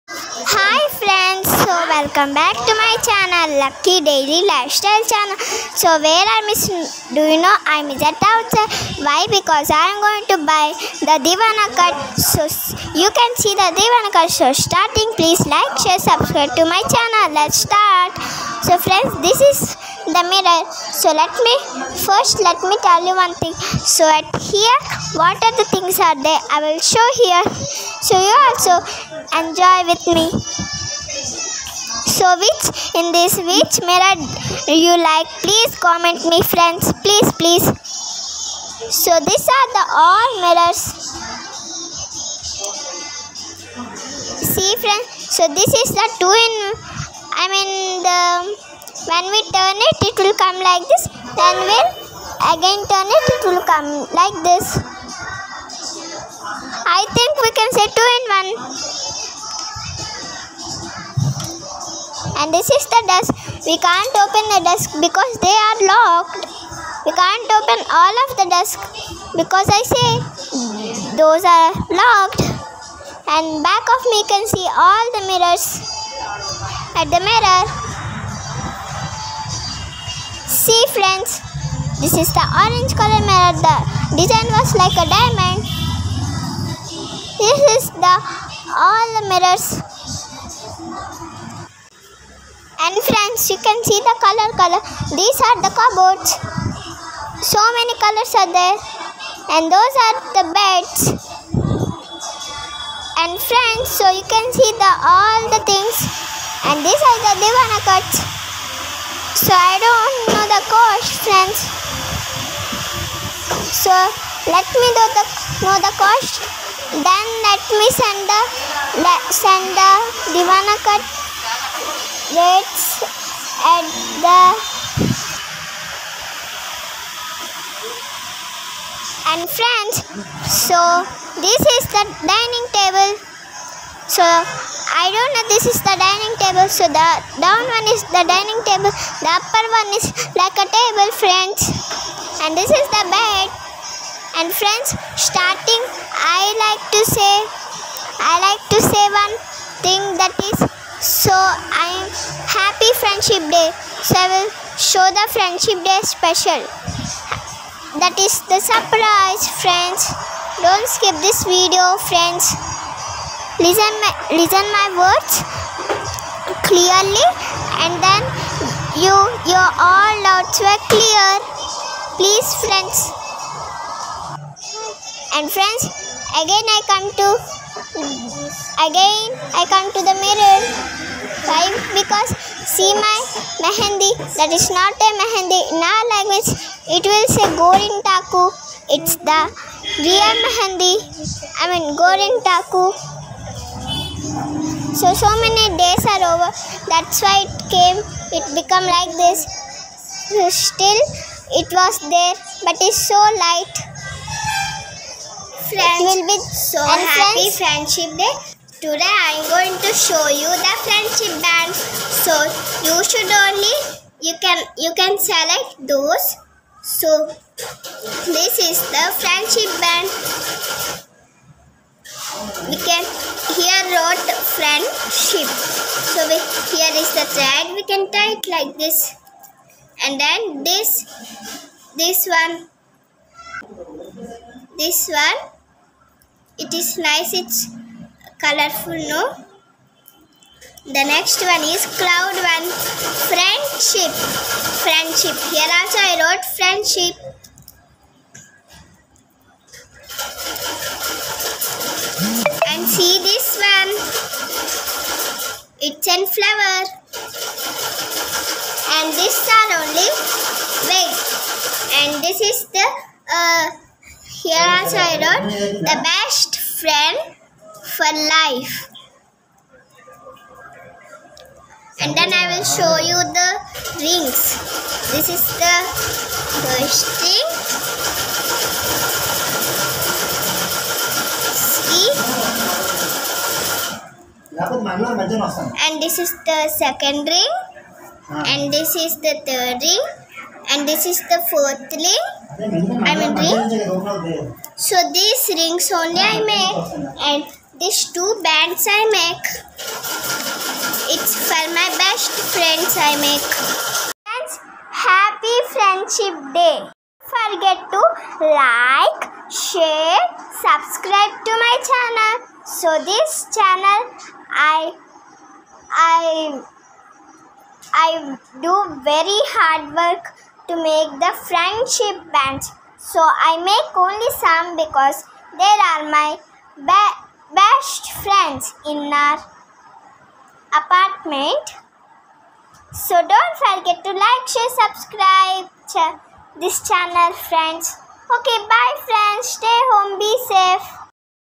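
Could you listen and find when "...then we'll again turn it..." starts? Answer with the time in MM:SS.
00:51.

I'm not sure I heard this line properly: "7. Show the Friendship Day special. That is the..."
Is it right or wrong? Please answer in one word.
right.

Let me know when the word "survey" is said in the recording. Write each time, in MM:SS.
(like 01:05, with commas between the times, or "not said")
not said.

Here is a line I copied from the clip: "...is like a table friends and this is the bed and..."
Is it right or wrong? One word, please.
right.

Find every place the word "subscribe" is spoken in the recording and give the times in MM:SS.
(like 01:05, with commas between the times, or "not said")
00:16, 05:10, 05:34.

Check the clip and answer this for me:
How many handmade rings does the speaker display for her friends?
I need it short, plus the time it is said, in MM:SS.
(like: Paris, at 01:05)
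4, at 04:51.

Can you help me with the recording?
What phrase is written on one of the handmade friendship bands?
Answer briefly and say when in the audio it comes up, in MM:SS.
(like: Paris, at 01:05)
Best friend for life, at 04:26.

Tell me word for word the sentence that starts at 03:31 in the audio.
So you should only you can you can select those.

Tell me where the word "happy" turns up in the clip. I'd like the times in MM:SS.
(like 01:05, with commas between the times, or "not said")
03:26, 05:05.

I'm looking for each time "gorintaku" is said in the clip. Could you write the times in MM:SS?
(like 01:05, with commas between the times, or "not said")
03:07, 03:12.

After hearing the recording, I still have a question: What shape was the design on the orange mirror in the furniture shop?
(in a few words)
Diamond.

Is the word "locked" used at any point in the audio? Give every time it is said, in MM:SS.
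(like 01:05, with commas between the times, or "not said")
01:05, 01:12.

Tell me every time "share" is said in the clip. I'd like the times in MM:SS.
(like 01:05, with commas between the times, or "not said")
00:15, 05:09, 05:34.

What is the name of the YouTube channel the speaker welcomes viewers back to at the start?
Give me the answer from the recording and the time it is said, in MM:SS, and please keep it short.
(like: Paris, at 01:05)
Lucky Daily Lifestyle, at 00:03.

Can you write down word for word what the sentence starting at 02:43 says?
Listen my, listen my words clearly and then you your all doubts were clear.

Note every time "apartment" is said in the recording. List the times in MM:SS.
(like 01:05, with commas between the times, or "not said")
05:30.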